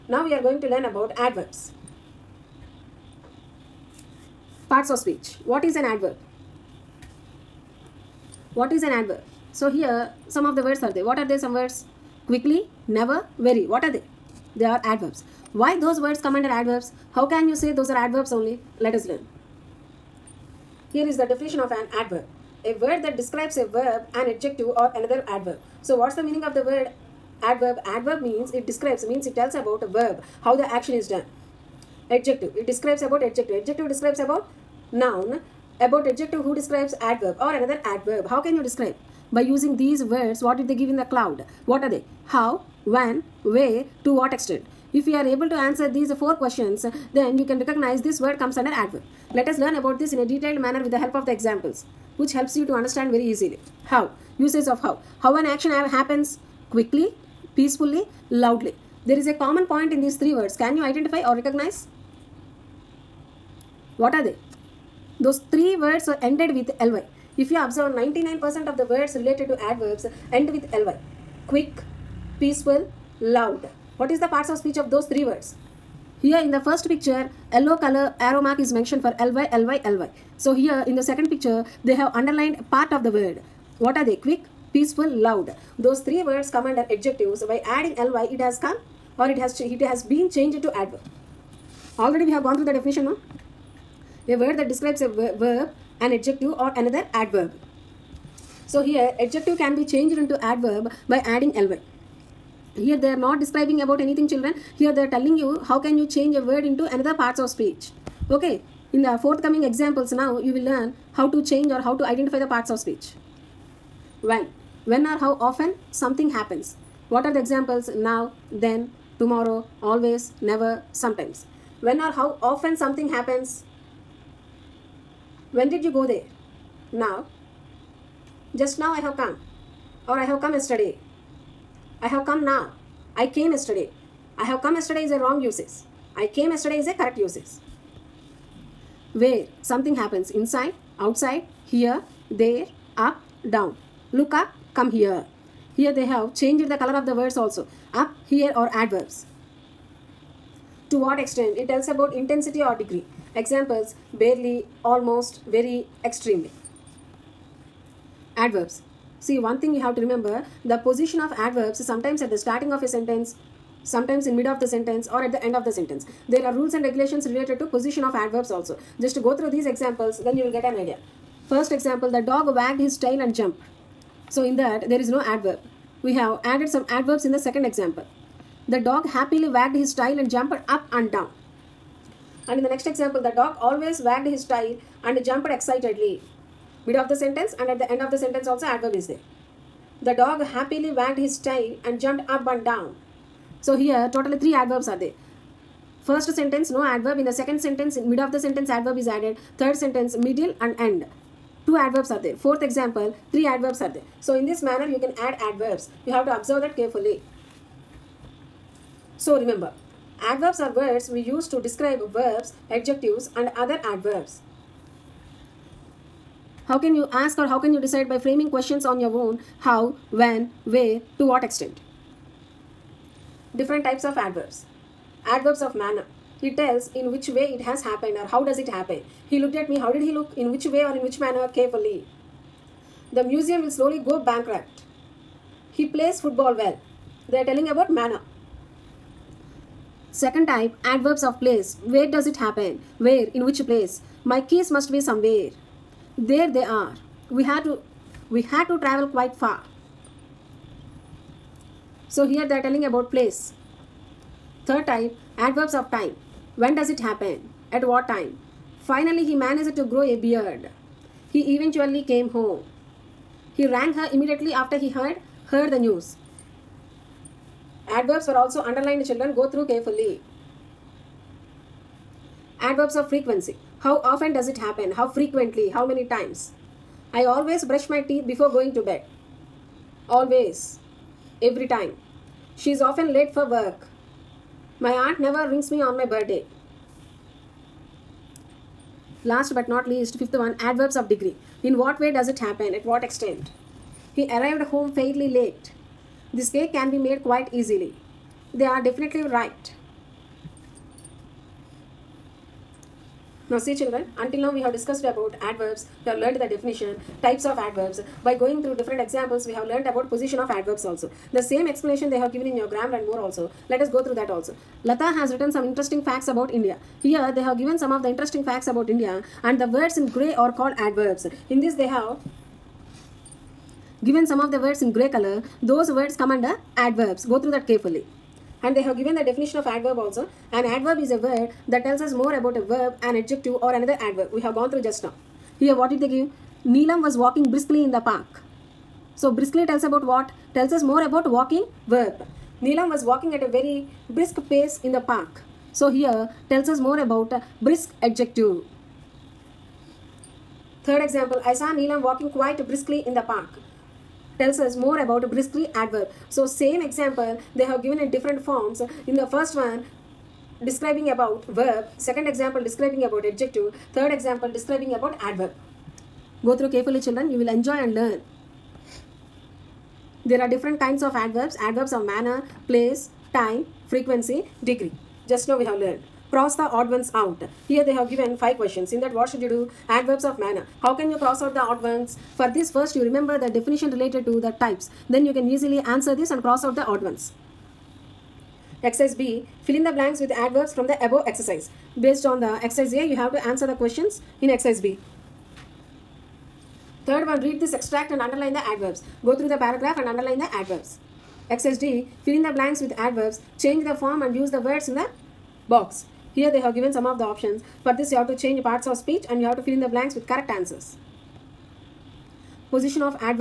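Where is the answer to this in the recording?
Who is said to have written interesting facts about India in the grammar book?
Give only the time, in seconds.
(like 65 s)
314 s.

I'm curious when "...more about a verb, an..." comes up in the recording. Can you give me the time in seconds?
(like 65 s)
332 s.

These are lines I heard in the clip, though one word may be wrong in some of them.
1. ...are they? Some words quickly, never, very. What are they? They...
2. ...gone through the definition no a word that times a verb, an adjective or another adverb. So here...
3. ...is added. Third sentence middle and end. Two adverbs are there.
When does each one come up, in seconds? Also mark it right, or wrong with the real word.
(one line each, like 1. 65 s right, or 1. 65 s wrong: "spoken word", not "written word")
1. 11 s right
2. 92 s wrong: "describes", not "times"
3. 198 s right.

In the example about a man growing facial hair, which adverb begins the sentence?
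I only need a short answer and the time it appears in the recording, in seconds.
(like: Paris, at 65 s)
Finally, at 258 s.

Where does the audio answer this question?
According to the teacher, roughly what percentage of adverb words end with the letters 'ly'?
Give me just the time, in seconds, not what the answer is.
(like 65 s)
67 s.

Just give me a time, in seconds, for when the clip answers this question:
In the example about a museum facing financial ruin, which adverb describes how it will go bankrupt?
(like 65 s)
233 s.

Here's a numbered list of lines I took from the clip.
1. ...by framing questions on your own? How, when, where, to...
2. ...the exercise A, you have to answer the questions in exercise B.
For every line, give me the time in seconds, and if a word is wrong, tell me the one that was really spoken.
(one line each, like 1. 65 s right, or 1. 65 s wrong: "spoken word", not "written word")
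1. 218 s right
2. 392 s right.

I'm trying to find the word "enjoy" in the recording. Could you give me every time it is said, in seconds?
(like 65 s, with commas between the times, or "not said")
367 s.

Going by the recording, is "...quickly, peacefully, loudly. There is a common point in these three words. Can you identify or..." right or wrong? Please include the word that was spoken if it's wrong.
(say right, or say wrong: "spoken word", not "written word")
right.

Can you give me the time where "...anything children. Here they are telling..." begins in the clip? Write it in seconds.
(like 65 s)
104 s.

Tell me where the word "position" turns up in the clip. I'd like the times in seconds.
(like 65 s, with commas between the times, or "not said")
160 s, 167 s, 310 s, 412 s.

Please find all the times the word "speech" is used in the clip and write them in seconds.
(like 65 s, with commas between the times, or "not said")
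4 s, 74 s, 107 s, 112 s, 408 s.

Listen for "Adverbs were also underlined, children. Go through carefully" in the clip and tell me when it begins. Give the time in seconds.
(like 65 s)
267 s.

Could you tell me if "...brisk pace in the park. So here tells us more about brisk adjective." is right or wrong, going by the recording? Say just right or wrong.
right.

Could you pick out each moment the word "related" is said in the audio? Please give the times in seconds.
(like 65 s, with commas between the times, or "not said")
69 s, 167 s, 383 s.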